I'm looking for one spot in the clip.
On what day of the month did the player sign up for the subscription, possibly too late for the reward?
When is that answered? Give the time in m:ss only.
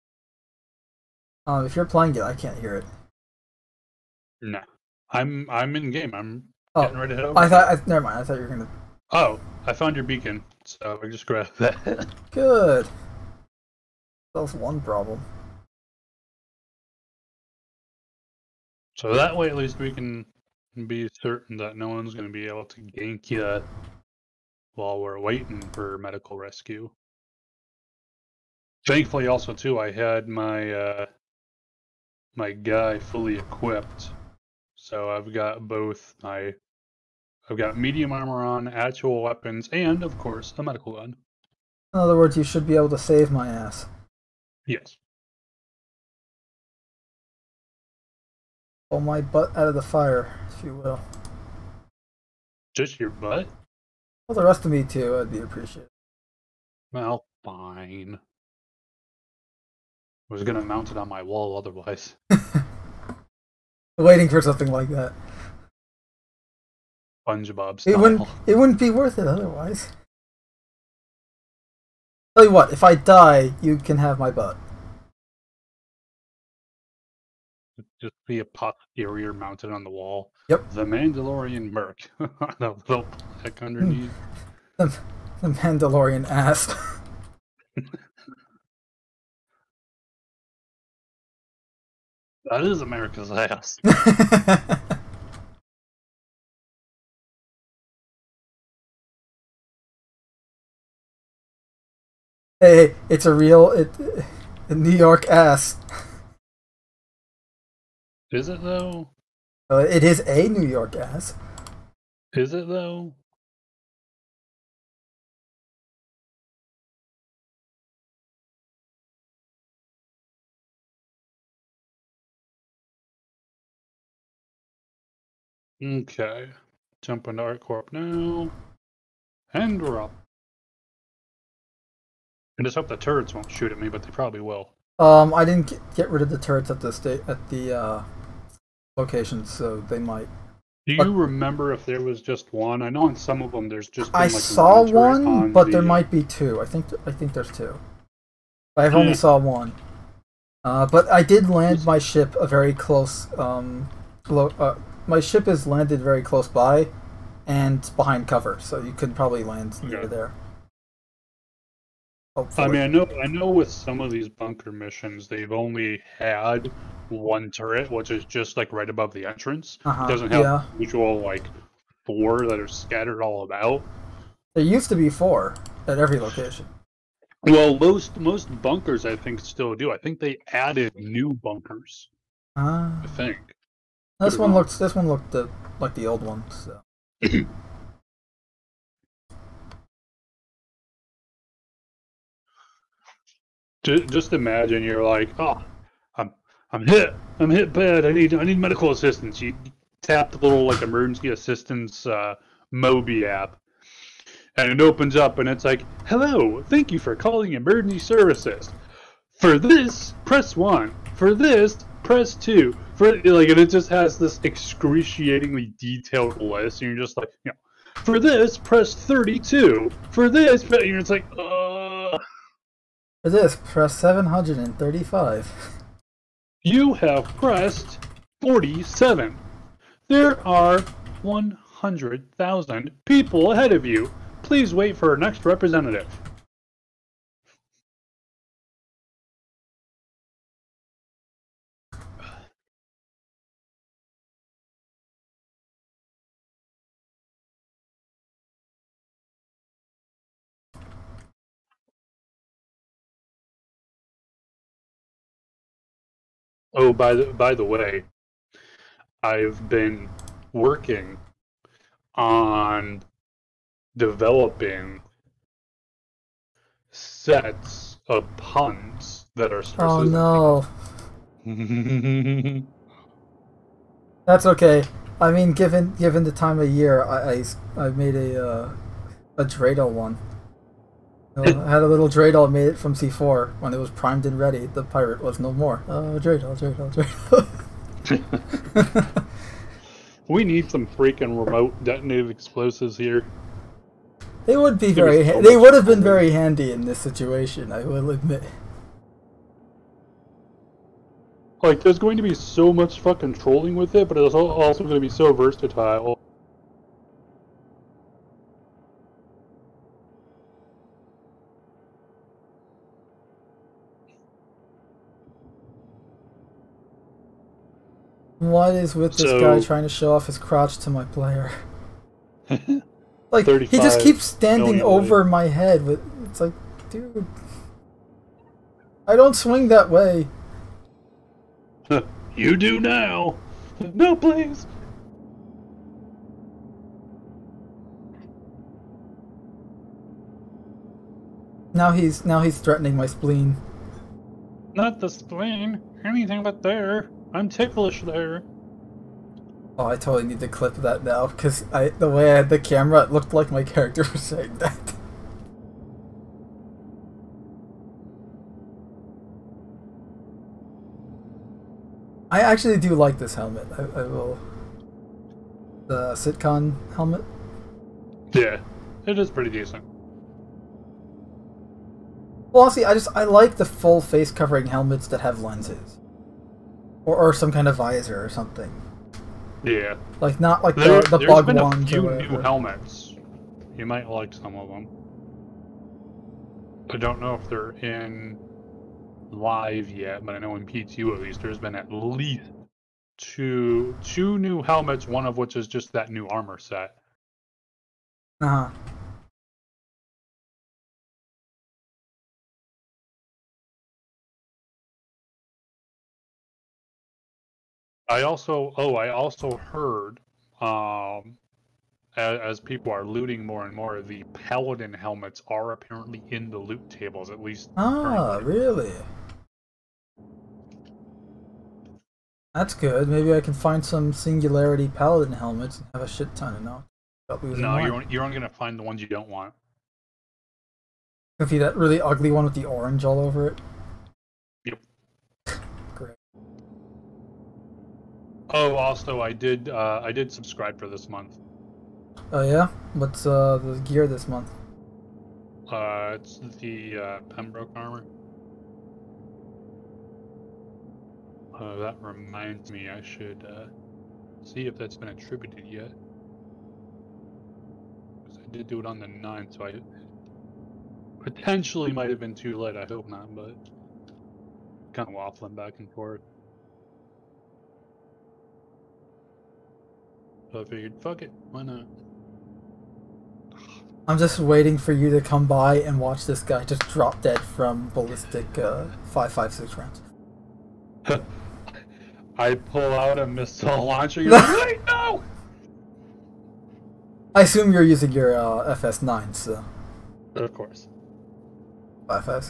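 7:39.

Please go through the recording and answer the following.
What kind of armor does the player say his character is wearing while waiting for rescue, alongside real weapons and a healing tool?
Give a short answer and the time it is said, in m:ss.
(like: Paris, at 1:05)
medium armor, at 0:37.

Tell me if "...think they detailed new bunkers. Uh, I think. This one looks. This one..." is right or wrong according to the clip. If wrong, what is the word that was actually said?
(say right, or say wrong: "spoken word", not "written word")
wrong: "added", not "detailed".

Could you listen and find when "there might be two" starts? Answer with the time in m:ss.
2:25.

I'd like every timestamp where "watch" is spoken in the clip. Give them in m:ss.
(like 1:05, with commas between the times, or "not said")
7:55.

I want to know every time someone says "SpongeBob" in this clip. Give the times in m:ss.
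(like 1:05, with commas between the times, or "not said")
1:07.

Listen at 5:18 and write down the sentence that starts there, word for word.
What is with this so, guy trying to show off his crotch to my player?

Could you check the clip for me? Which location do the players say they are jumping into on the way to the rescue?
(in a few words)
ArcCorp.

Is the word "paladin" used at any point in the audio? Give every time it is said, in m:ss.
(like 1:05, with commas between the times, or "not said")
6:54, 7:04.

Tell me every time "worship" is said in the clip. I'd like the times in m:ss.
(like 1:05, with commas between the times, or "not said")
not said.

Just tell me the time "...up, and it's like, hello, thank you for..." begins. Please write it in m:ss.
3:25.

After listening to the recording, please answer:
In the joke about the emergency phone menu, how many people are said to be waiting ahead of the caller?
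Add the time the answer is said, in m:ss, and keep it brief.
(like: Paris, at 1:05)
100000, at 3:51.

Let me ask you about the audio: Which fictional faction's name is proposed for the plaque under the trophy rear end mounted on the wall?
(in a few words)
Mandalorian Merc.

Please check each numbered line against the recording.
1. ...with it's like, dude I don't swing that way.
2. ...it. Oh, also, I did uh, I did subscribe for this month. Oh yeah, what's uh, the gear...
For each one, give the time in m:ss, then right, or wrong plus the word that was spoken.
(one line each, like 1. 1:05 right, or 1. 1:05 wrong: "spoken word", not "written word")
1. 5:25 right
2. 7:13 right.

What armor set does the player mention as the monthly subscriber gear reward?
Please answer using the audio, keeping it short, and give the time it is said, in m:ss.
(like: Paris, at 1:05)
Pembroke armor, at 7:27.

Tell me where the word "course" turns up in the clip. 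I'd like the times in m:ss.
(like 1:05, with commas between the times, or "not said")
0:40, 8:10.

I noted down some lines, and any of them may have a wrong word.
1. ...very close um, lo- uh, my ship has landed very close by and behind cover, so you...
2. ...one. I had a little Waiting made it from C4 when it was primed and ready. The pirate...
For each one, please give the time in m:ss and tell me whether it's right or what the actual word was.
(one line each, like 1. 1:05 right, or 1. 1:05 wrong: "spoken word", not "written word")
1. 2:32 right
2. 4:39 wrong: "Dreidel", not "Waiting".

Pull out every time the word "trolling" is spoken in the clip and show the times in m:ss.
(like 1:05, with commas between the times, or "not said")
5:03.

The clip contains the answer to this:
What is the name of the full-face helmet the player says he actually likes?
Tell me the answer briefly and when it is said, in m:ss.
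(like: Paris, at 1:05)
CitCon helmet, at 6:06.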